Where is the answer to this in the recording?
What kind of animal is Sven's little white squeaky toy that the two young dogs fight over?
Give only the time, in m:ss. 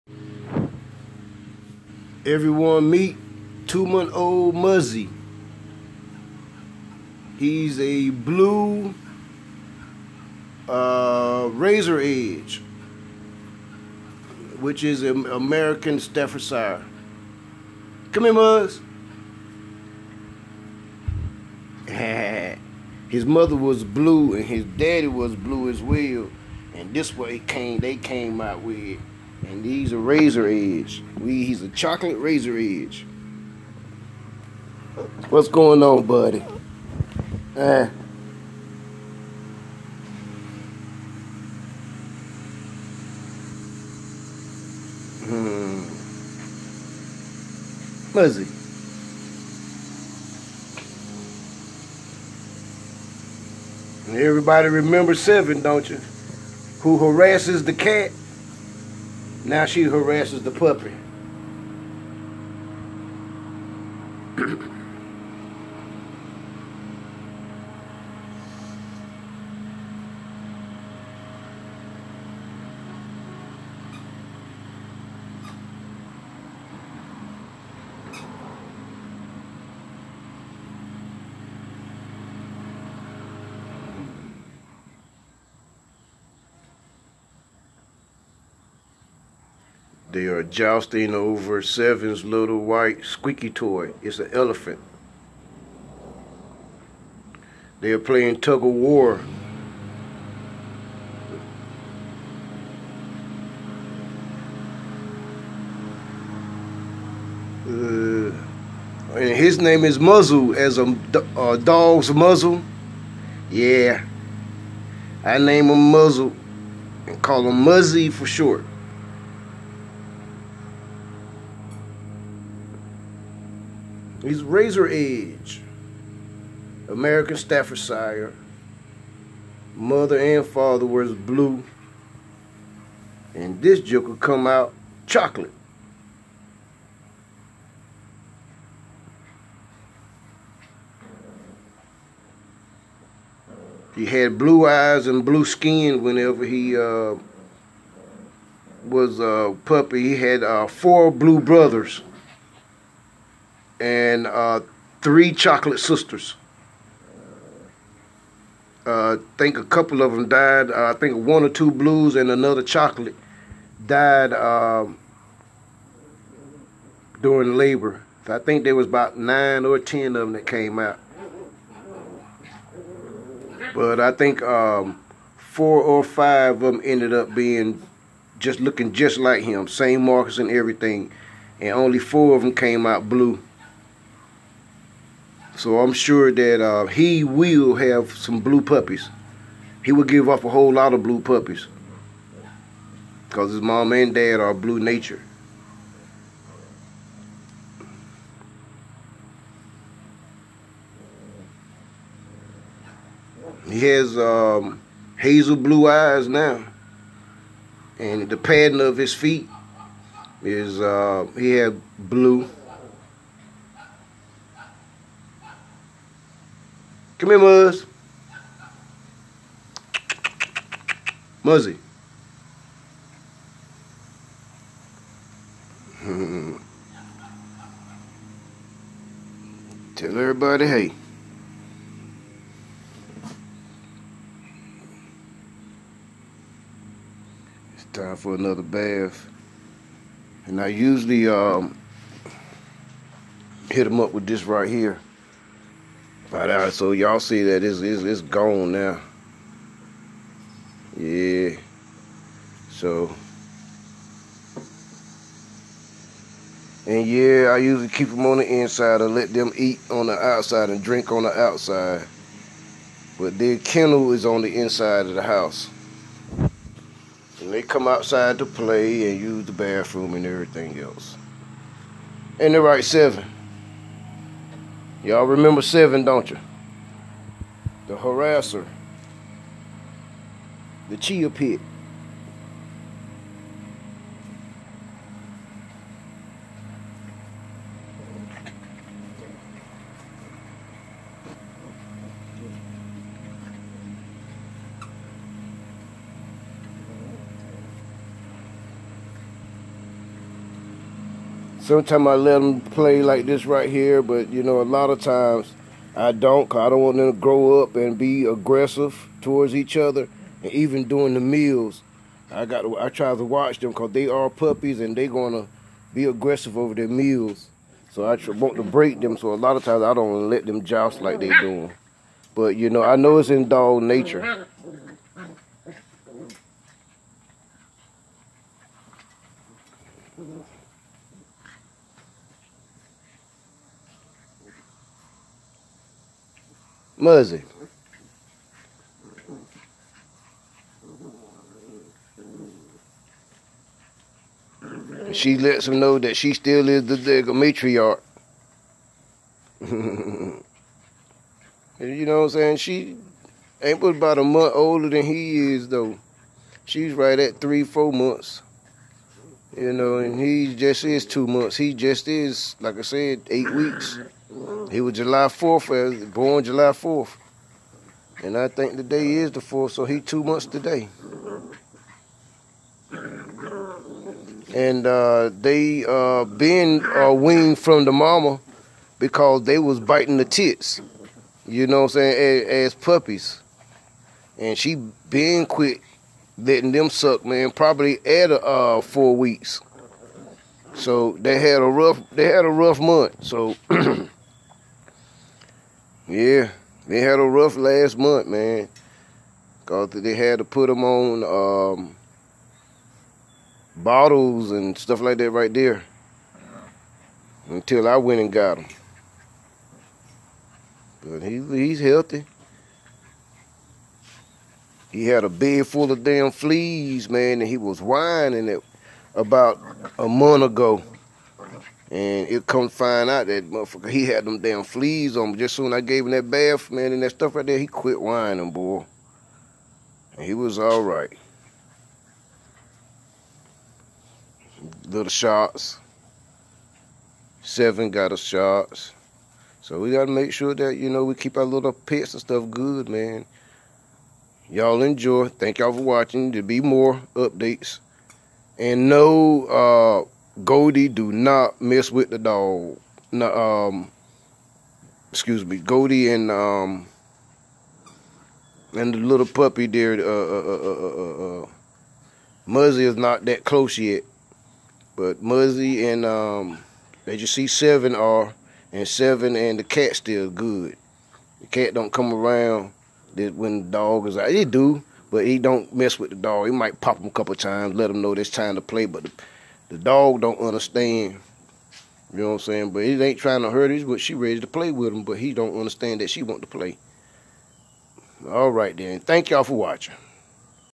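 1:34.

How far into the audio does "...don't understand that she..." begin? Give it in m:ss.
8:05.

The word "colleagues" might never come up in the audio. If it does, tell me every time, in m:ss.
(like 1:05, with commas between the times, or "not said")
not said.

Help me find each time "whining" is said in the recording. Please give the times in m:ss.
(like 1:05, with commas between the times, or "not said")
6:57, 7:07.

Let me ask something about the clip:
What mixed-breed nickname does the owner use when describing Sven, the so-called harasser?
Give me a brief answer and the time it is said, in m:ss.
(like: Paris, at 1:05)
Chia pit, at 4:40.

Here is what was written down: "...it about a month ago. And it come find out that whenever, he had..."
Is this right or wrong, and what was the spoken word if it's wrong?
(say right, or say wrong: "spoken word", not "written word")
wrong: "motherfucker", not "whenever".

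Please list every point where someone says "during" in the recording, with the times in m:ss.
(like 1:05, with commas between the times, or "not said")
2:47, 5:10.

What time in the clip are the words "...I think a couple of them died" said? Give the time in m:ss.
2:39.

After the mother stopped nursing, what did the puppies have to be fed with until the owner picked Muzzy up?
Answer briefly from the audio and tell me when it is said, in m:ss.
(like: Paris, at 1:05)
Bottles, at 6:43.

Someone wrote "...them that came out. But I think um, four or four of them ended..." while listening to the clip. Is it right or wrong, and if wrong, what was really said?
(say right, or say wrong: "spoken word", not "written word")
wrong: "five", not "four".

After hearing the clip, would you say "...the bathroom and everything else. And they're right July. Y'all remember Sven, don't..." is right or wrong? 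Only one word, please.
wrong.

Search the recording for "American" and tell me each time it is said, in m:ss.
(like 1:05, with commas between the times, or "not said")
0:15, 2:06.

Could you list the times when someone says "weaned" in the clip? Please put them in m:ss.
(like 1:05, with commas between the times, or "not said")
6:17.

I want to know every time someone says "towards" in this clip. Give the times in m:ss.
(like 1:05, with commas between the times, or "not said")
5:09.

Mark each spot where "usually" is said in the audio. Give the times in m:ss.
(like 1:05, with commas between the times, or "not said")
4:00, 4:17.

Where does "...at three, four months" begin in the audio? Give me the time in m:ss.
5:57.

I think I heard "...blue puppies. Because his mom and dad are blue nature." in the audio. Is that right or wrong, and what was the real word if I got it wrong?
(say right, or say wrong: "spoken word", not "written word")
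right.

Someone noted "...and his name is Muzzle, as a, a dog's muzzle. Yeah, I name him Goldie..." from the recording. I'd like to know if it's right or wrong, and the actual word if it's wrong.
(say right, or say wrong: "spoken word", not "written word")
wrong: "Muzzle", not "Goldie".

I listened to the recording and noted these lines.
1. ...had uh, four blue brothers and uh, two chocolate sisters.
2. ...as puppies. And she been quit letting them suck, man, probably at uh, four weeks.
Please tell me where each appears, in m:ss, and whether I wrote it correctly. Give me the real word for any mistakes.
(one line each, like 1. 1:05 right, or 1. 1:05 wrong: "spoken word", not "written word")
1. 2:30 wrong: "three", not "two"
2. 6:22 right.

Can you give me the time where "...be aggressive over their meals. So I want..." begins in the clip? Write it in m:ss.
5:15.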